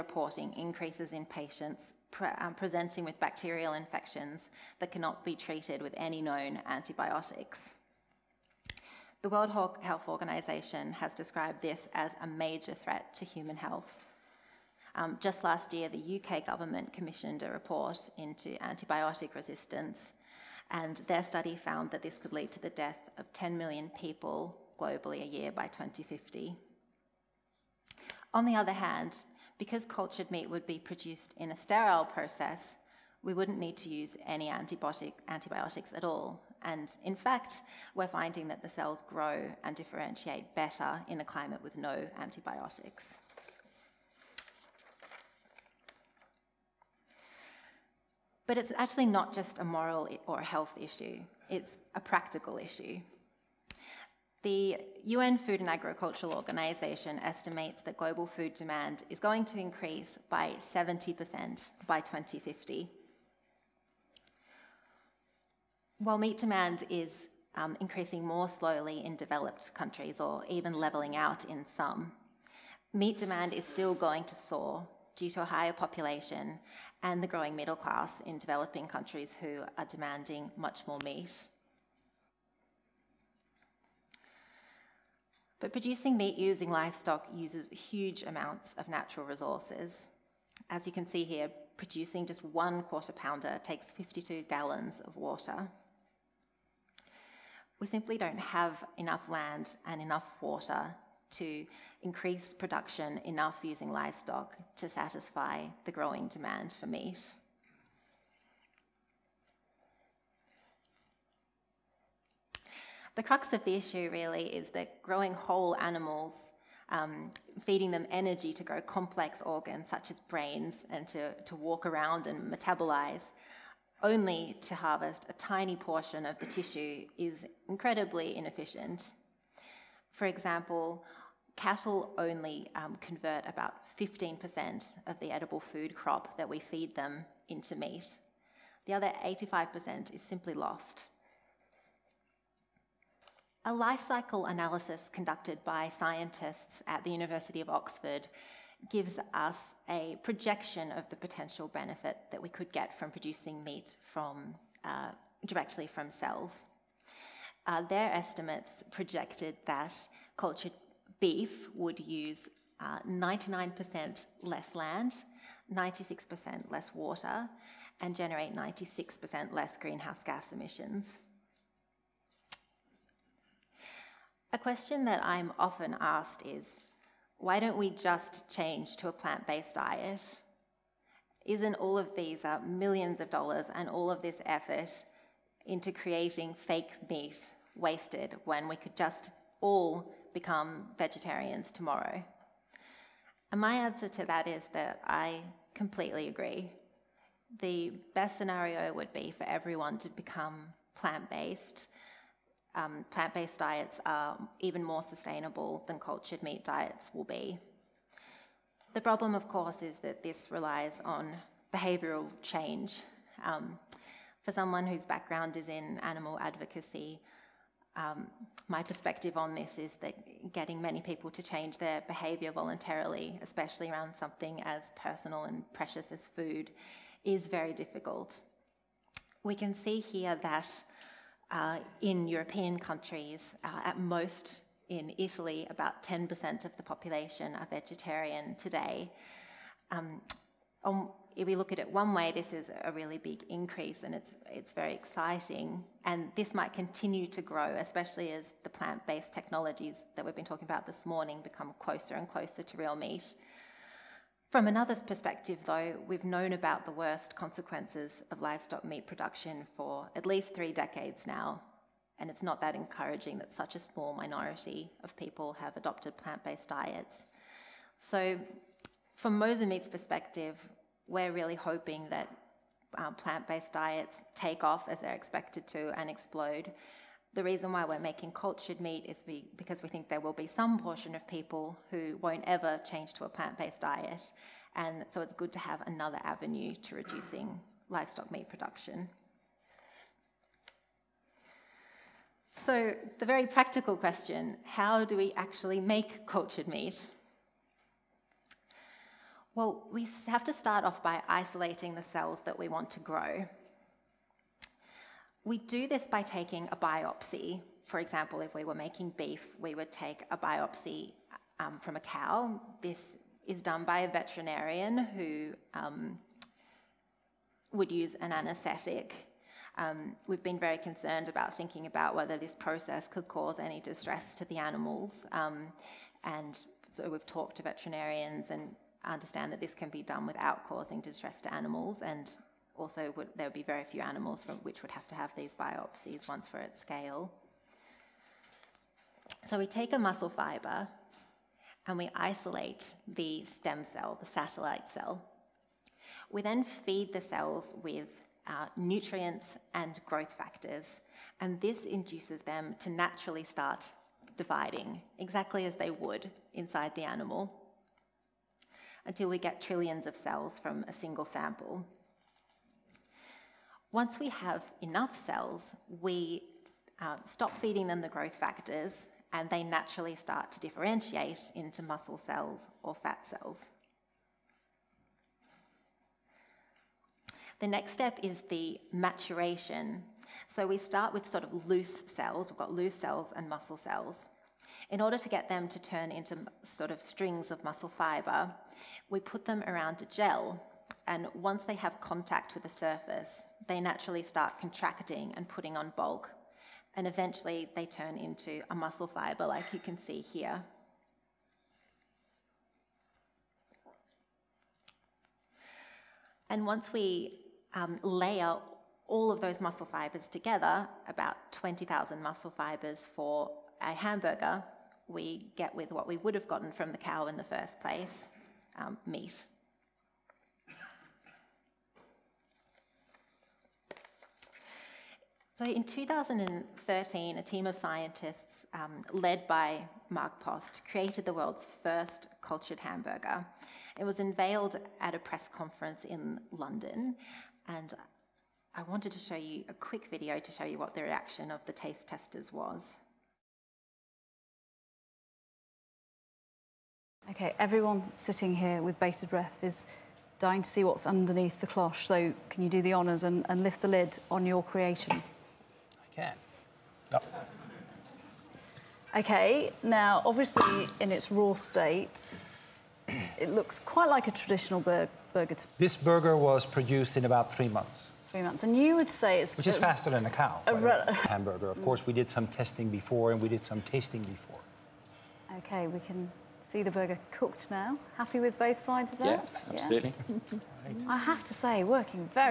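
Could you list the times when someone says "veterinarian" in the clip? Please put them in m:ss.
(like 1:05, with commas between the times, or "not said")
5:14, 5:27.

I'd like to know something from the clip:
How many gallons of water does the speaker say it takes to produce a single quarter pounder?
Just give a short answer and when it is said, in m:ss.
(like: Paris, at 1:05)
52, at 1:33.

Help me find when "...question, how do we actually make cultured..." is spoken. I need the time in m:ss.
4:53.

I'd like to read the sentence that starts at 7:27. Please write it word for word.
Okay, everyone sitting here with bated breath is dying to see what's underneath the cloche.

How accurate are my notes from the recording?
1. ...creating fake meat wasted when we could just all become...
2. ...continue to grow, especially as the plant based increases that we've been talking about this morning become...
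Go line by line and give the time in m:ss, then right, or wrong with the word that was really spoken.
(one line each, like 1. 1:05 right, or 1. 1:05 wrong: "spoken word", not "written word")
1. 3:05 right
2. 4:06 wrong: "technologies", not "increases".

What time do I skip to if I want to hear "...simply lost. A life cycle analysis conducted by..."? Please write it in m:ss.
2:20.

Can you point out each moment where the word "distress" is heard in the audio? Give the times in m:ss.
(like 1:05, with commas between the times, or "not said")
5:23, 5:31.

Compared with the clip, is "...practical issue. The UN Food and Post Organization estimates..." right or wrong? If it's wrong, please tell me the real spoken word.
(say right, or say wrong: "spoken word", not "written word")
wrong: "Agricultural", not "Post".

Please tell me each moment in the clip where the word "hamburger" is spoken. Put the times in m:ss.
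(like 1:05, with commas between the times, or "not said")
6:53, 7:12, 7:51.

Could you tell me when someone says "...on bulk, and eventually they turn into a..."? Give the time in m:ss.
6:35.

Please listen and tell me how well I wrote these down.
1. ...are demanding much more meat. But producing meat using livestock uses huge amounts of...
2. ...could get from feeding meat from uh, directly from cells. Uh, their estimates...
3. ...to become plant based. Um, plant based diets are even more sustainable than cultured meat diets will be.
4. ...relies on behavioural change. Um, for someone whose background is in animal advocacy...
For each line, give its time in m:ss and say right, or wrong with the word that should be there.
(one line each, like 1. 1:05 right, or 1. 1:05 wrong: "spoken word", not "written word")
1. 1:19 right
2. 2:32 wrong: "producing", not "feeding"
3. 3:19 right
4. 3:30 right.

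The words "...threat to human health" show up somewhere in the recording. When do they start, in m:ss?
0:12.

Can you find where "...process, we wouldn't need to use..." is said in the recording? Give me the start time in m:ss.
0:32.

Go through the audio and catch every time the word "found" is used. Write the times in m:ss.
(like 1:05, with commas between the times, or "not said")
0:21.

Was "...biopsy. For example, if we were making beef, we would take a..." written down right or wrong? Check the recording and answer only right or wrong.
right.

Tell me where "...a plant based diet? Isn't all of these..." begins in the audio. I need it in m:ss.
2:59.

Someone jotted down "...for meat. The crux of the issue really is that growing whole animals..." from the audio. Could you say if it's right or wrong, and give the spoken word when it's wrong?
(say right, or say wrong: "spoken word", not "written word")
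right.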